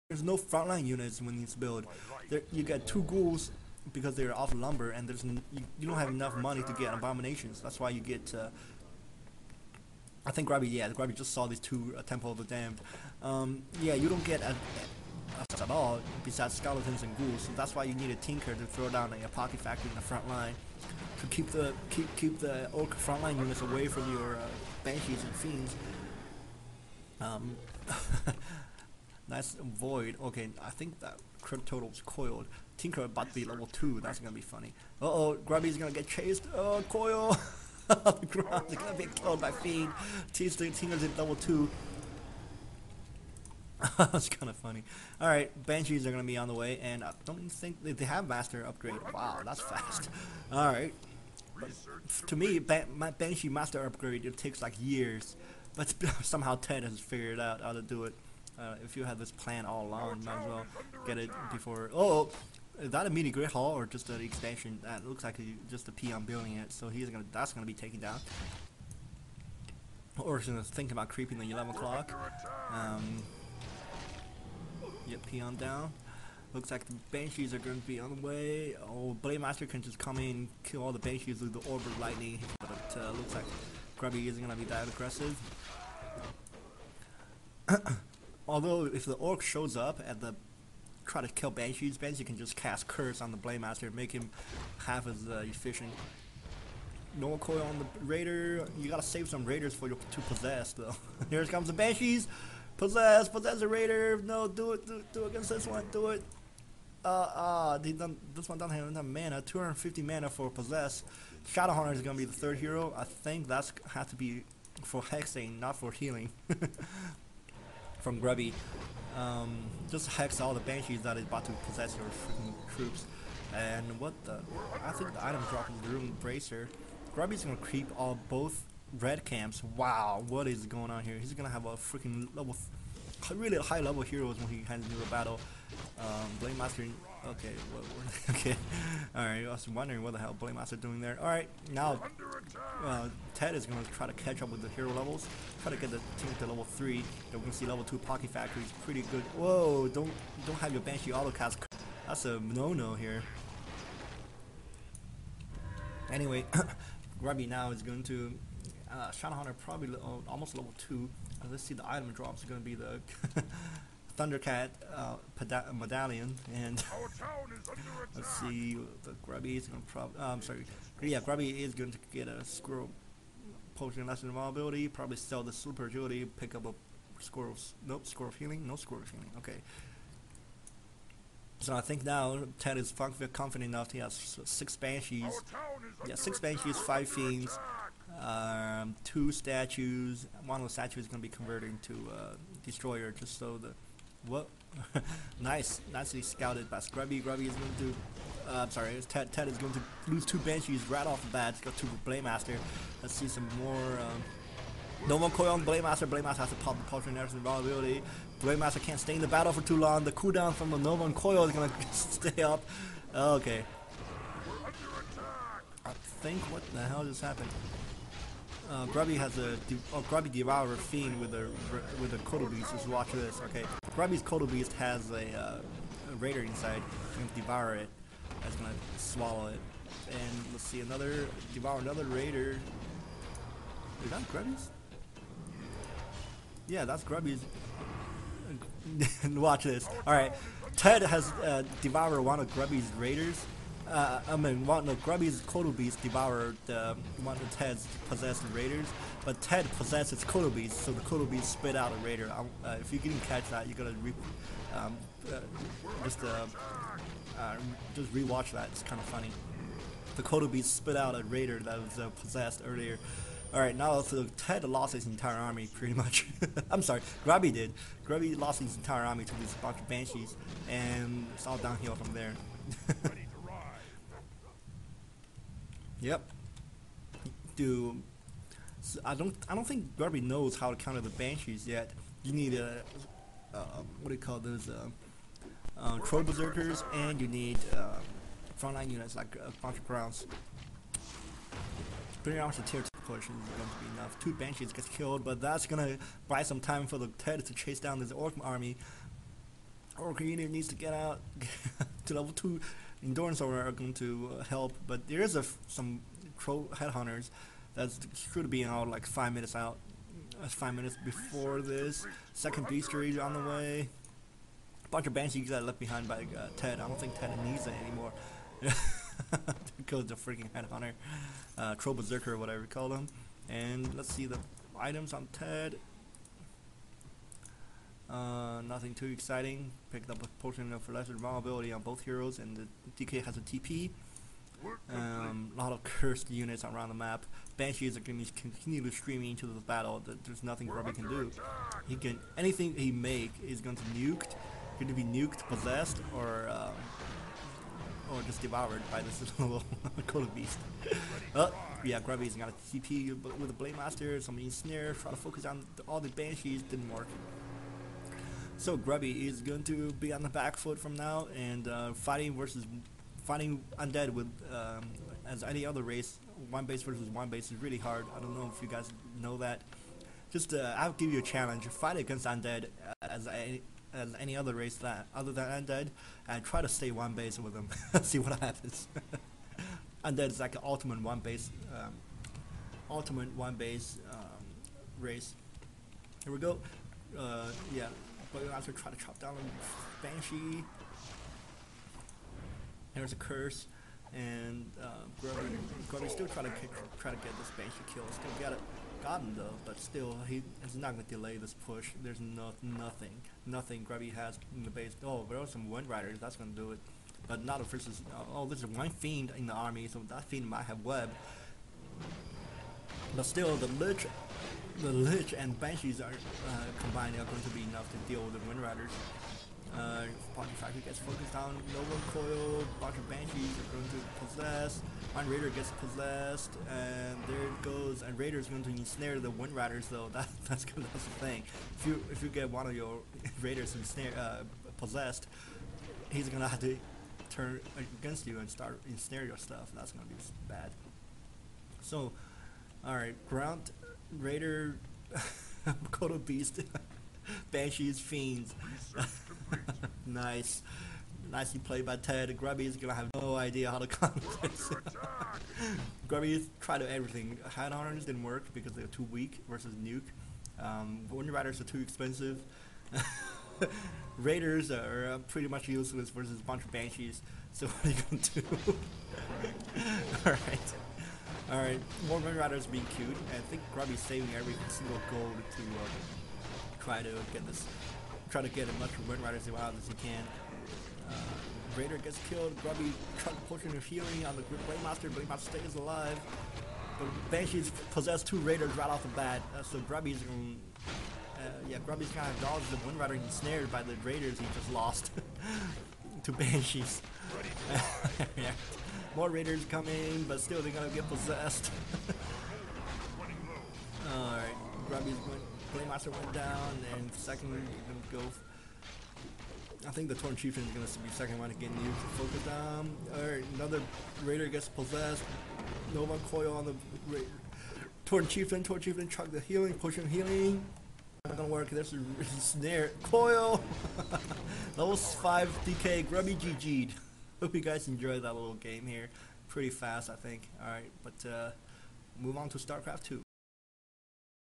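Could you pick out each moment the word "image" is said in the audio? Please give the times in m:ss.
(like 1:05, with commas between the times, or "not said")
not said.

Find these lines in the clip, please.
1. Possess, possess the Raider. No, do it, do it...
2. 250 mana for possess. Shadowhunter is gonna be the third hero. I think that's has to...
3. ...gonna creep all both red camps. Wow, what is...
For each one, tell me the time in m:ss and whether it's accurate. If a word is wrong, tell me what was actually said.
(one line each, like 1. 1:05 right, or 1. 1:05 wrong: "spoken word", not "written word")
1. 1:42 right
2. 1:49 right
3. 2:07 right.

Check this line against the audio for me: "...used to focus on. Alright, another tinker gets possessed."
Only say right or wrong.
wrong.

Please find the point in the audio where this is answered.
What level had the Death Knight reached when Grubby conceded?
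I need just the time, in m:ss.
8:44.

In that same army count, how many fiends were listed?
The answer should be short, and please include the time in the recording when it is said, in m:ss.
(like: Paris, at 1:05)
5, at 3:06.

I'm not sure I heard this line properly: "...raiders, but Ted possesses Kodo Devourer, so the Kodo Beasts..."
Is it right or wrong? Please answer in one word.
wrong.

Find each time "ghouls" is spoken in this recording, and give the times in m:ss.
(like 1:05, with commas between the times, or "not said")
0:03, 0:17.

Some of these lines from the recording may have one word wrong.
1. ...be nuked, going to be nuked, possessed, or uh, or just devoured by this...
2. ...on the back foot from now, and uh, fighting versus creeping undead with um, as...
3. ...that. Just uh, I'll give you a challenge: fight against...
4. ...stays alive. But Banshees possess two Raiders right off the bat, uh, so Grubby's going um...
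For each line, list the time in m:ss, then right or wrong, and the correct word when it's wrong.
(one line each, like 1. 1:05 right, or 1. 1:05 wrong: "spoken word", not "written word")
1. 5:43 right
2. 6:00 wrong: "fighting", not "creeping"
3. 6:09 right
4. 8:05 right.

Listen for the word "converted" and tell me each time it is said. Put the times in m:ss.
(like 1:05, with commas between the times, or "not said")
3:11.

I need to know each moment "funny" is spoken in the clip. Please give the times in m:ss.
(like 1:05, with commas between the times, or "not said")
0:34, 0:44, 4:19.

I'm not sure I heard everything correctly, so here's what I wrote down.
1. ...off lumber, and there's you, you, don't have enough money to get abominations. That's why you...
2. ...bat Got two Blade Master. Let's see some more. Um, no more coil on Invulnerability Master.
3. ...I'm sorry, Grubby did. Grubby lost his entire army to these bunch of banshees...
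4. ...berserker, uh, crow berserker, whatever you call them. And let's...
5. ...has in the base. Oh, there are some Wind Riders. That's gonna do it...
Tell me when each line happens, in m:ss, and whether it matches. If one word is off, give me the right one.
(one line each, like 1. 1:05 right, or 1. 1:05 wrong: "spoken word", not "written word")
1. 0:04 right
2. 3:21 wrong: "Blade", not "Invulnerability"
3. 4:26 right
4. 5:20 wrong: "headhunter", not "berserker"
5. 6:44 right.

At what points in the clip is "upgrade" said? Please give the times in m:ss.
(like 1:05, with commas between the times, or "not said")
0:48, 0:53.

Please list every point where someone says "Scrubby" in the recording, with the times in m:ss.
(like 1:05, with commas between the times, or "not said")
3:16.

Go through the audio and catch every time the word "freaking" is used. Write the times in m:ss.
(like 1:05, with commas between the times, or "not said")
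2:02, 2:11, 5:20.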